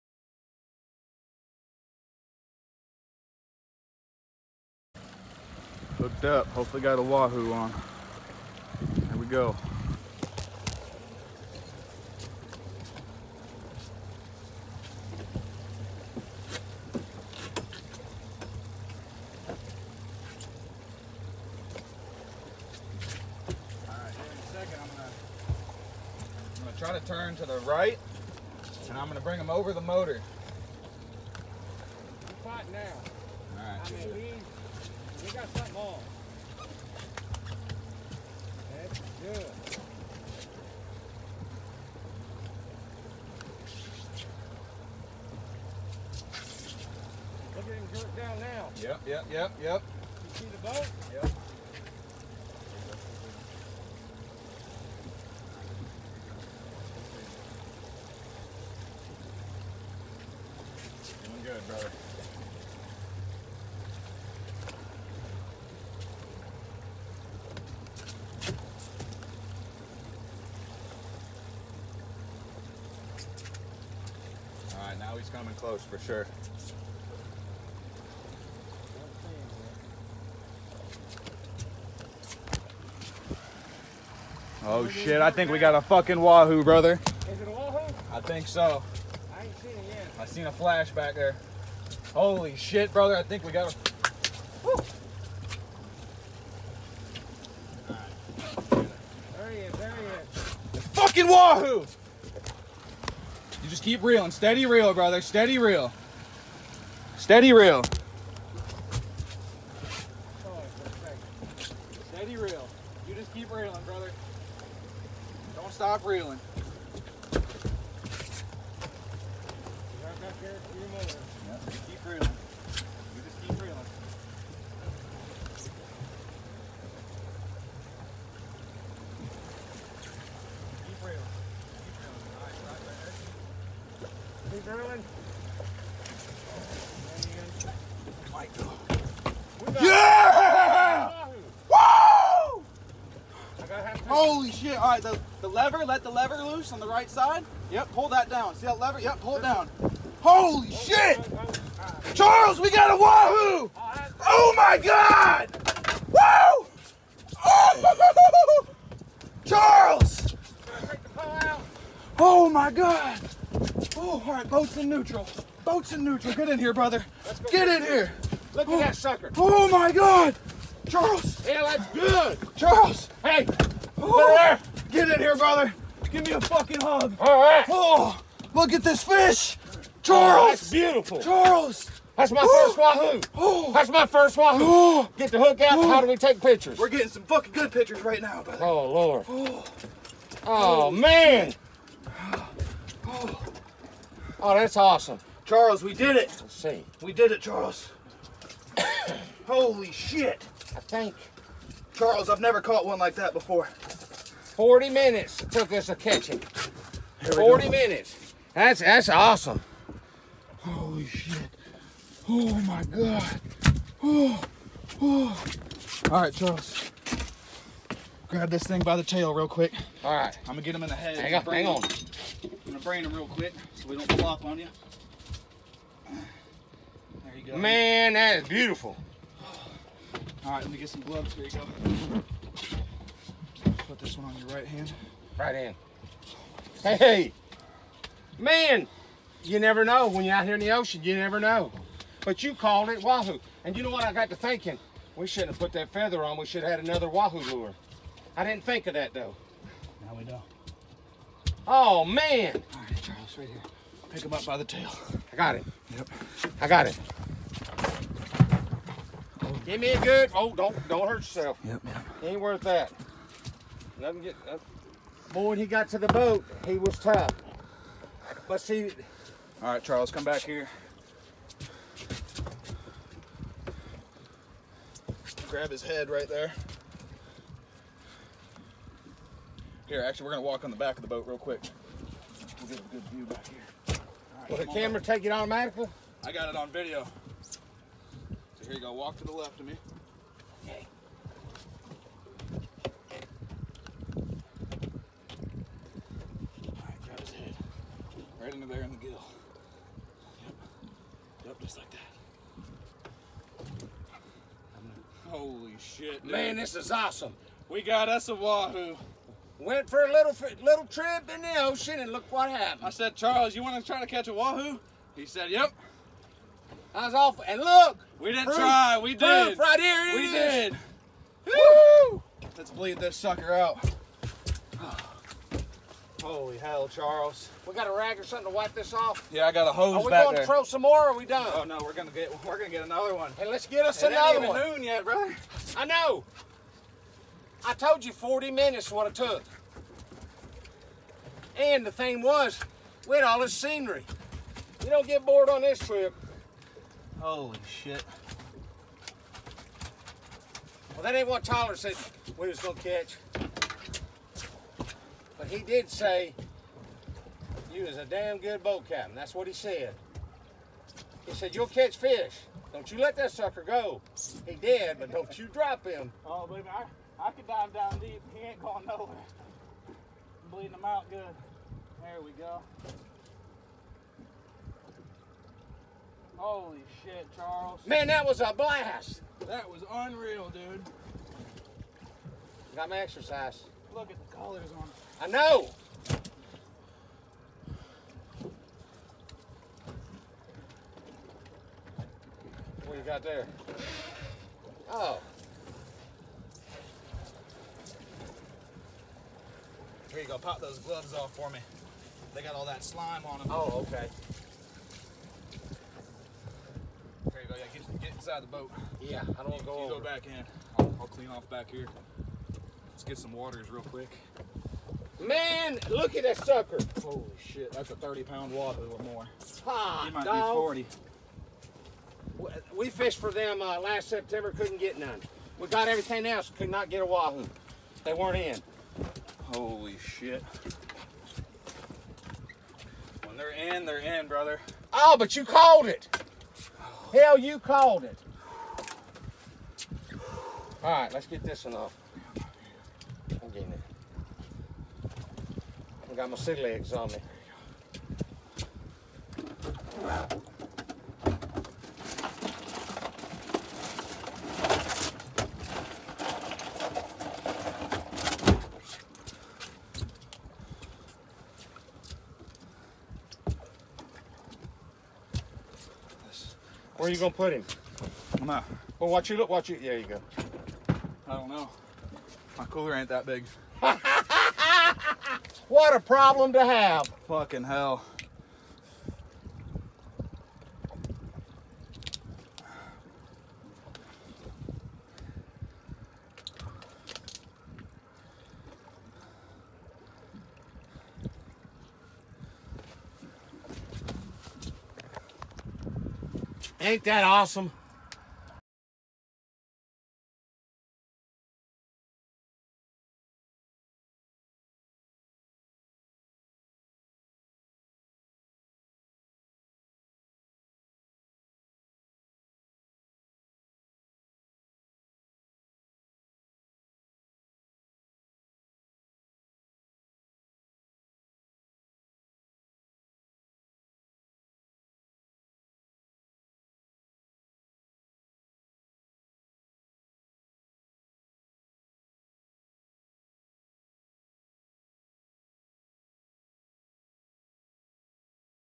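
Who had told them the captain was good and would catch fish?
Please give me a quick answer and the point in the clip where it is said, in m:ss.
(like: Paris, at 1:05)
Tyler, at 5:51.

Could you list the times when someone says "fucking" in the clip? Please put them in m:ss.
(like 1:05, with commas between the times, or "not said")
1:25, 1:40, 2:56, 3:07, 7:57.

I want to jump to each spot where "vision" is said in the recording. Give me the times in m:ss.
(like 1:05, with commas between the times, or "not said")
not said.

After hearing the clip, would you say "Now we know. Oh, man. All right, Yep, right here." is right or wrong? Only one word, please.
wrong.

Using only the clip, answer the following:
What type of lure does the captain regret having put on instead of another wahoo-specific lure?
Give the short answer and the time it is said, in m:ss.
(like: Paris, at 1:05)
feather, at 4:05.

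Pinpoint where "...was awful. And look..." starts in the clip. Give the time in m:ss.
5:17.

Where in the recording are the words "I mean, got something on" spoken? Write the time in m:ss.
0:34.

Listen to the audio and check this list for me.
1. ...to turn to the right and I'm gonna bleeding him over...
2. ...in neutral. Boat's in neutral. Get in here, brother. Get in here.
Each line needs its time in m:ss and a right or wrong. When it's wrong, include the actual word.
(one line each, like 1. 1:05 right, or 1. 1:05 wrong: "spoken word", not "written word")
1. 0:26 wrong: "bring", not "bleeding"
2. 2:44 right.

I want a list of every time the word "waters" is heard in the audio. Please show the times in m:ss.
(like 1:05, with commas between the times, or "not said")
6:53, 6:58.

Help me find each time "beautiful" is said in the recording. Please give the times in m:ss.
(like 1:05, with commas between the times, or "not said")
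3:00, 3:48.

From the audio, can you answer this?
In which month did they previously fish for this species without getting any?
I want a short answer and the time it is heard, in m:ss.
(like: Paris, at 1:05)
September, at 7:03.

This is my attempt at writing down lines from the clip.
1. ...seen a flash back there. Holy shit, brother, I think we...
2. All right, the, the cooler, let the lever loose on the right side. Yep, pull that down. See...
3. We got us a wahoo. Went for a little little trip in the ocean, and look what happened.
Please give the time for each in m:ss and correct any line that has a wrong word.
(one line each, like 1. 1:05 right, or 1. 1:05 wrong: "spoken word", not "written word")
1. 1:30 right
2. 2:24 wrong: "lever", not "cooler"
3. 5:07 right.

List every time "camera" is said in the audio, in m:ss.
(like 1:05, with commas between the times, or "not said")
4:44.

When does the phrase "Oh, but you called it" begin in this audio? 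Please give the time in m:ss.
7:14.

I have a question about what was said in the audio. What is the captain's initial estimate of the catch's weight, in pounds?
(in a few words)
30.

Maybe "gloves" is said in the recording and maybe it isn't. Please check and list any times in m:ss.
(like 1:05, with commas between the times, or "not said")
3:51, 6:40.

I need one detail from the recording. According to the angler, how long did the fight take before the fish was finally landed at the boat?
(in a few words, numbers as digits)
40 minutes.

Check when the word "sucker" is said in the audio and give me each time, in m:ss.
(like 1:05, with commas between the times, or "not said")
2:48, 5:23, 6:03, 6:56.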